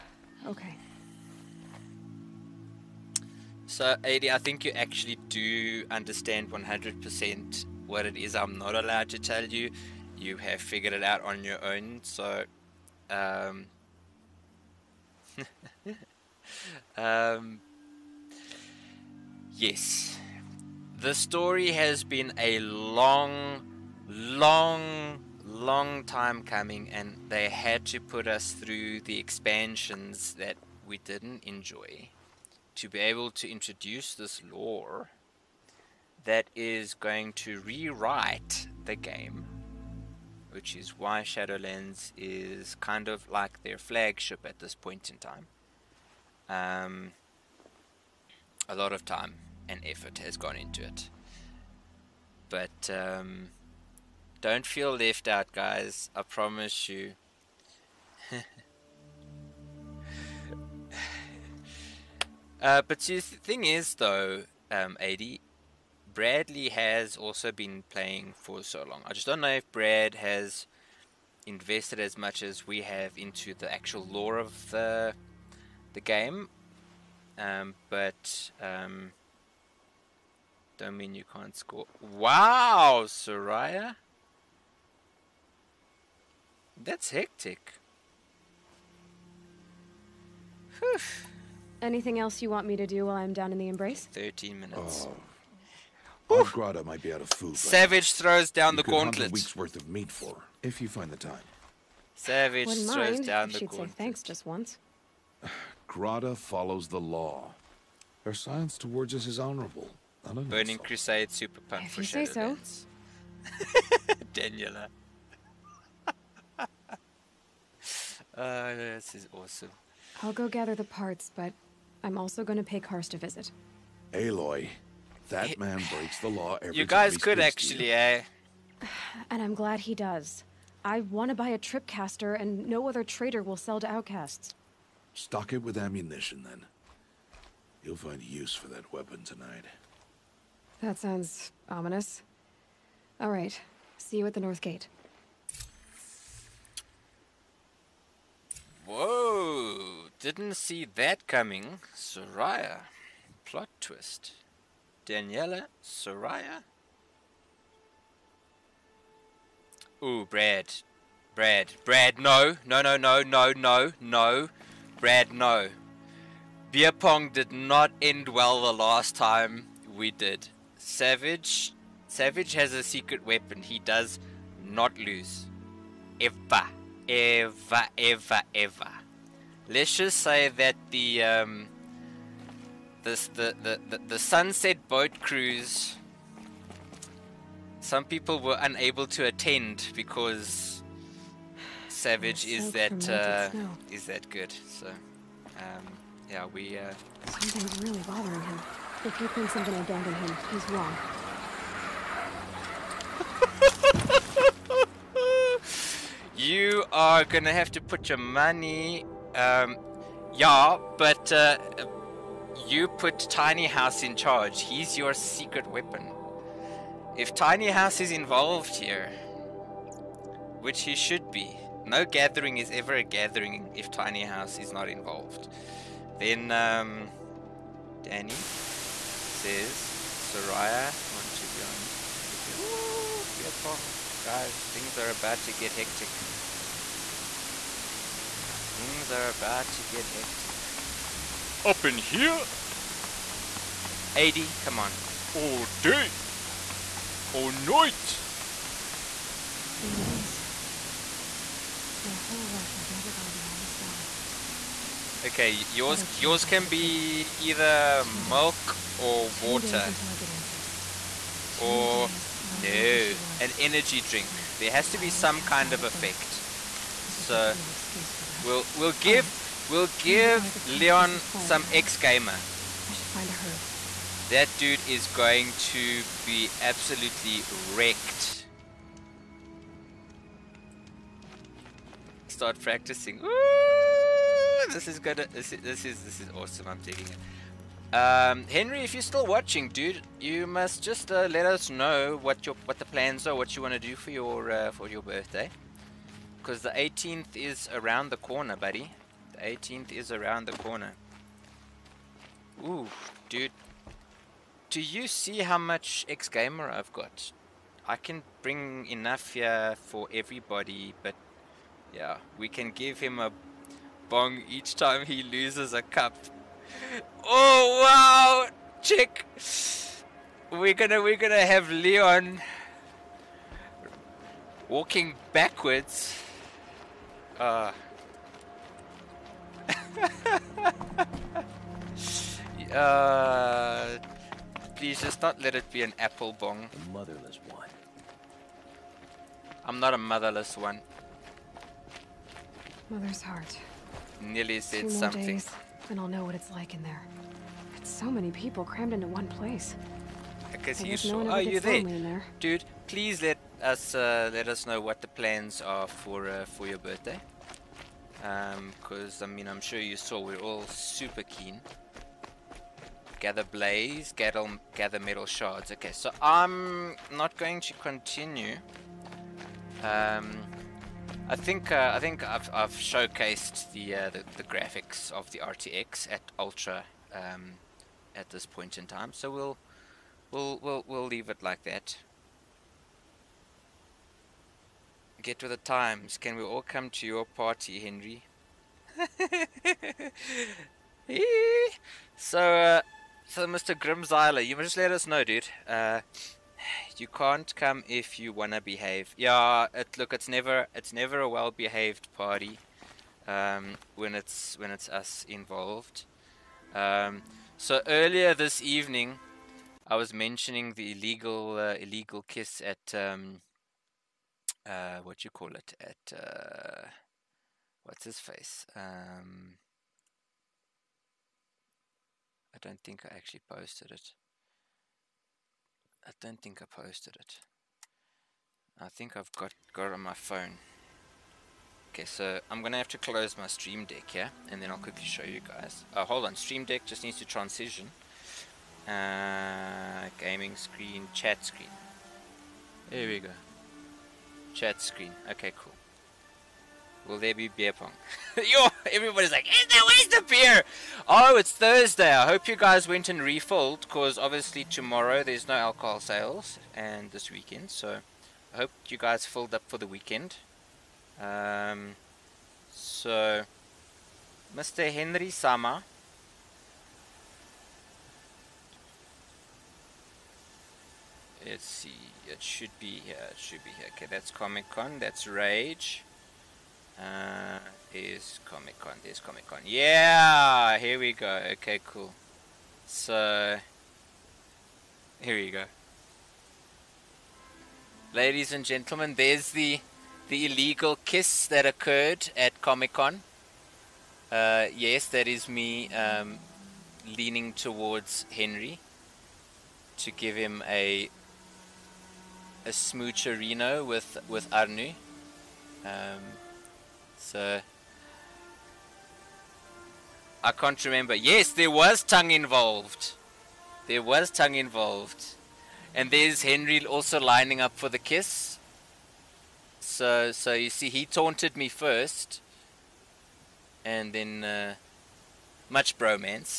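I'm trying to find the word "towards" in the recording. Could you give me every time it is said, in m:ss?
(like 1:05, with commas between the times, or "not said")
1:48, 8:17.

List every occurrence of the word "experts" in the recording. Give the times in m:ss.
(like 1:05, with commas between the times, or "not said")
not said.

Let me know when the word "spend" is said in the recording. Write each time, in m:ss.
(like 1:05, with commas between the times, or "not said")
not said.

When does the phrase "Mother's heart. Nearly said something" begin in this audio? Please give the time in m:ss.
5:42.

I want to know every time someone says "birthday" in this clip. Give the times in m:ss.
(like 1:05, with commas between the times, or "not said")
4:54, 5:56.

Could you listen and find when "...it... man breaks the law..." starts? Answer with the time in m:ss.
2:05.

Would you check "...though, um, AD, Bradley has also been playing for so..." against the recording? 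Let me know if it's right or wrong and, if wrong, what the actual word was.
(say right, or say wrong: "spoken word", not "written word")
right.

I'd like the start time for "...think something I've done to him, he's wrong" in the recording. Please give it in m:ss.
3:19.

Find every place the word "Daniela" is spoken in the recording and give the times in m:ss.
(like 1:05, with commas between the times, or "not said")
1:54, 2:35.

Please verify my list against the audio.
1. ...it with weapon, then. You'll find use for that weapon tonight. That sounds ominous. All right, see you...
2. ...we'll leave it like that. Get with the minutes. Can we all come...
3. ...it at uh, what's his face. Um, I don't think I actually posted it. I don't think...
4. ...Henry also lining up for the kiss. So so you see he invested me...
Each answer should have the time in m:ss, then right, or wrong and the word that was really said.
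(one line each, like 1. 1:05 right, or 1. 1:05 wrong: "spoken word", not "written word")
1. 2:15 wrong: "ammunition", not "weapon"
2. 6:20 wrong: "times", not "minutes"
3. 6:55 right
4. 8:36 wrong: "taunted", not "invested".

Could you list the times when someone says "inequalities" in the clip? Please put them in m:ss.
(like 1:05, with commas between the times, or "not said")
not said.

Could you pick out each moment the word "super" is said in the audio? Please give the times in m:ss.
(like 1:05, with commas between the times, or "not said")
1:51, 6:00.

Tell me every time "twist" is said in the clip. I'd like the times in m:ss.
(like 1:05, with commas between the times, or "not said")
2:33.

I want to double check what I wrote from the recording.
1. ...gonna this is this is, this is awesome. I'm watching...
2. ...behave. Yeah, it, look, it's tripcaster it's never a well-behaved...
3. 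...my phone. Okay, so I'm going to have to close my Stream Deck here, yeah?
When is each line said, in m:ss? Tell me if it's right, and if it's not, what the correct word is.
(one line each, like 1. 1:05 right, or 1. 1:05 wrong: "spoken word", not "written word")
1. 4:44 wrong: "digging", not "watching"
2. 6:38 wrong: "never", not "tripcaster"
3. 7:10 right.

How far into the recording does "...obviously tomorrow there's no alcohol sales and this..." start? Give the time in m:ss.
7:34.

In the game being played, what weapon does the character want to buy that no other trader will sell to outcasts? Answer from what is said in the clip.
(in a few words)
tripcaster.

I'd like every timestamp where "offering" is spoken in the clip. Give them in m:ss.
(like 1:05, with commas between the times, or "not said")
not said.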